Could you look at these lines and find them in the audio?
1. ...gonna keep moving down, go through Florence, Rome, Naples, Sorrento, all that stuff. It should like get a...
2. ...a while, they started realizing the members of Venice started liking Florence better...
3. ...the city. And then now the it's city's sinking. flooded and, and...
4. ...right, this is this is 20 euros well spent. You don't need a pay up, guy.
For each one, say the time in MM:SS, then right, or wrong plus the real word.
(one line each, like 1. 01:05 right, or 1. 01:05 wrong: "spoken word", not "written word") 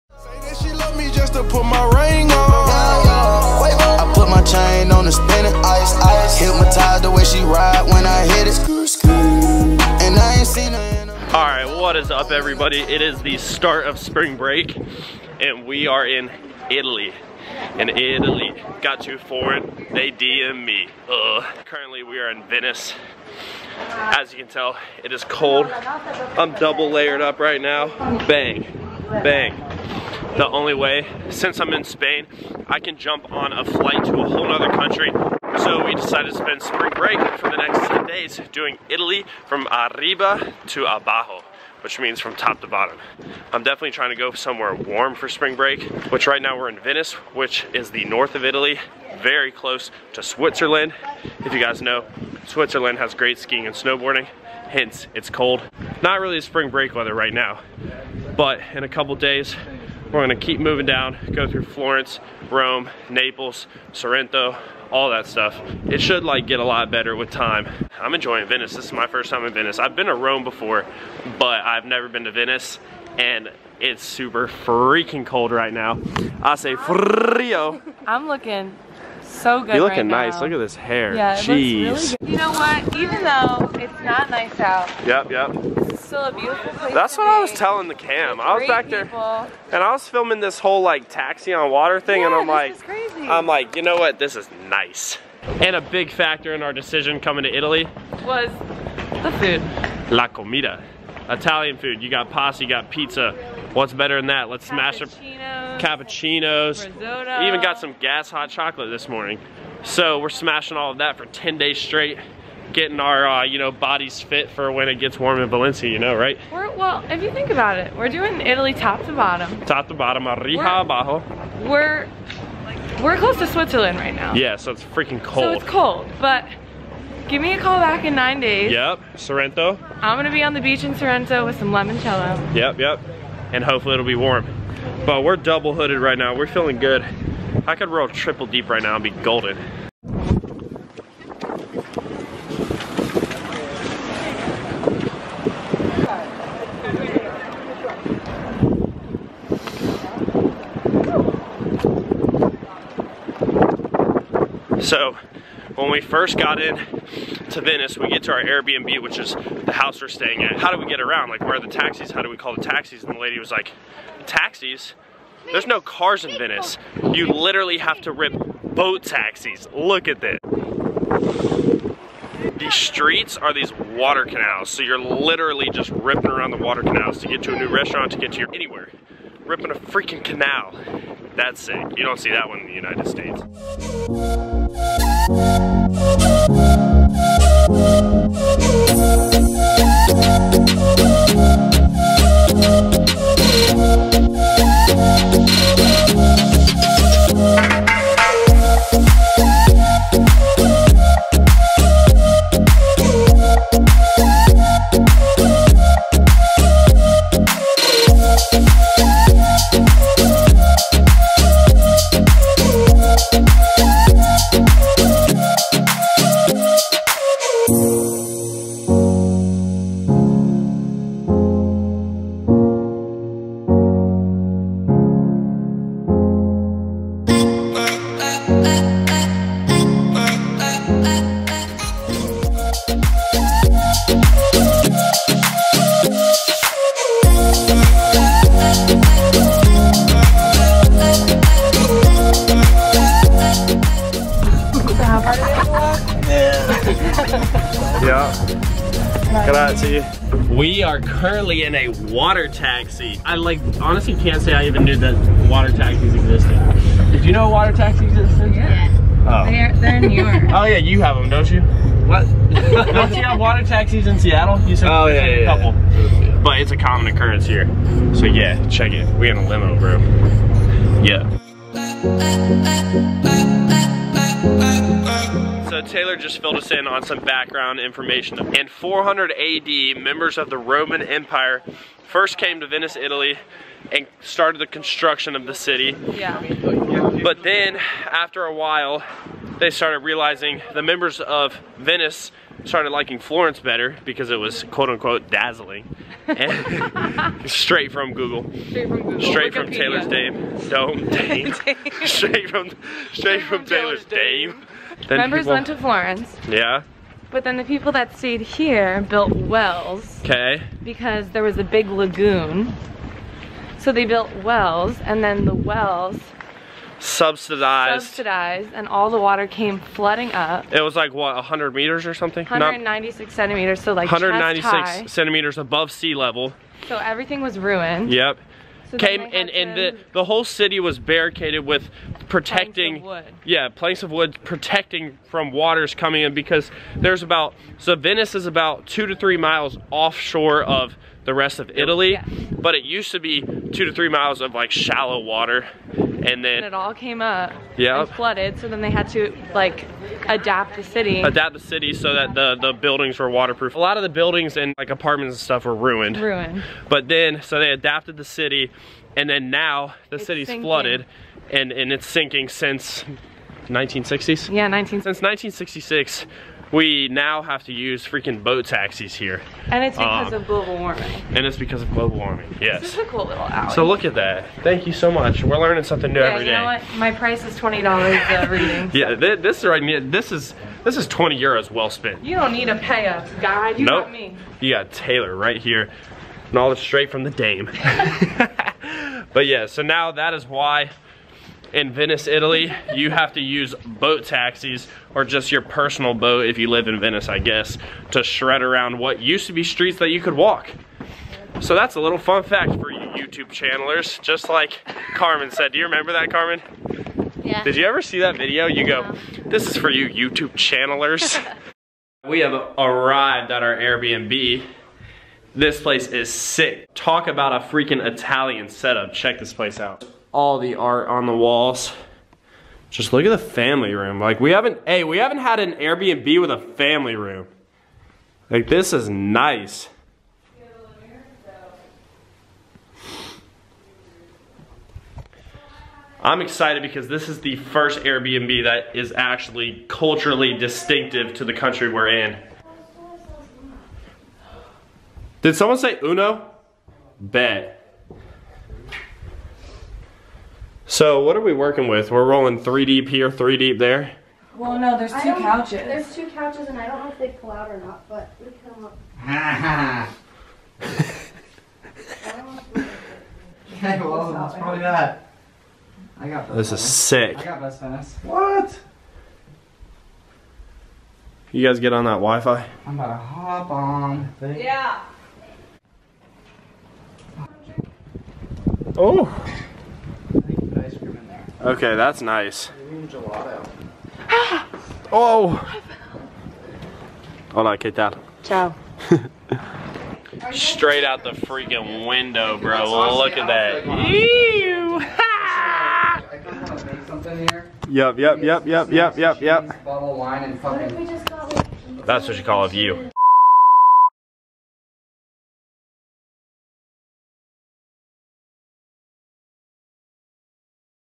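1. 01:00 right
2. 04:48 right
3. 05:58 right
4. 06:19 right.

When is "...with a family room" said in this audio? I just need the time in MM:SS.
07:06.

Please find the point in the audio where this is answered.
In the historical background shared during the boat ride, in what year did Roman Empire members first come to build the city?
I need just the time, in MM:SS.
04:38.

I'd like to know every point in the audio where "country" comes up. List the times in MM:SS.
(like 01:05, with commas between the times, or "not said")
00:34, 07:21.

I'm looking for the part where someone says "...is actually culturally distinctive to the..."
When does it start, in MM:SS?
07:18.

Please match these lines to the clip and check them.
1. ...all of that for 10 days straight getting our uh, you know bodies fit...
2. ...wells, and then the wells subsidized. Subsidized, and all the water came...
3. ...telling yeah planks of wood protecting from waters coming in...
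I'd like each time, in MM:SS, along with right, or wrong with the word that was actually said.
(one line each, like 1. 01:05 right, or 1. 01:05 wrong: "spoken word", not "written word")
1. 01:50 right
2. 05:14 right
3. 05:32 wrong: "protecting", not "telling".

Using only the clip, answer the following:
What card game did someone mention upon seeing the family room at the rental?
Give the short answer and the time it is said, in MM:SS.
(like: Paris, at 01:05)
Uno, at 07:26.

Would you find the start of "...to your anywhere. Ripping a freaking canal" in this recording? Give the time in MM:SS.
02:58.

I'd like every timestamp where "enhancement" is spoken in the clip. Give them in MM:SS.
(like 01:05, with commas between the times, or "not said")
not said.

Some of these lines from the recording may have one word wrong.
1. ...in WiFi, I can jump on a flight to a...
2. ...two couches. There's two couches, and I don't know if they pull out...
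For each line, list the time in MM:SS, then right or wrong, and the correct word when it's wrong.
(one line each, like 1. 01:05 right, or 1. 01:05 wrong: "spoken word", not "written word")
1. 00:31 wrong: "Spain", not "WiFi"
2. 07:35 right.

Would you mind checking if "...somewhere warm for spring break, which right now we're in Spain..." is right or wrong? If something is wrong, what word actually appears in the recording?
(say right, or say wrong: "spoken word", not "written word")
wrong: "Venice", not "Spain".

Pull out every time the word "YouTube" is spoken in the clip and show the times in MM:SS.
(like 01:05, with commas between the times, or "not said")
06:43, 06:50.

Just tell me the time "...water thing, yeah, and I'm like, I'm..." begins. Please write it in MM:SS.
01:31.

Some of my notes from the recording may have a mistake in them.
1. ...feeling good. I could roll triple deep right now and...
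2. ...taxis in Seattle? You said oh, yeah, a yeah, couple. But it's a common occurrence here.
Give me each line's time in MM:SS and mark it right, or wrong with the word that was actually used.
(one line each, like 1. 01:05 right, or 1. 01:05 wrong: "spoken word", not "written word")
1. 02:16 right
2. 04:23 right.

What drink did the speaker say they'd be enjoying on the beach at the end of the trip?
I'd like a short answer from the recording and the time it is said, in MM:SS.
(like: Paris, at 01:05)
Limoncello, at 02:11.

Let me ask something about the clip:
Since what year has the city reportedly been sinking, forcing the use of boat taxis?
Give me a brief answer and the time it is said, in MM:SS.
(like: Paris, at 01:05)
1966, at 06:05.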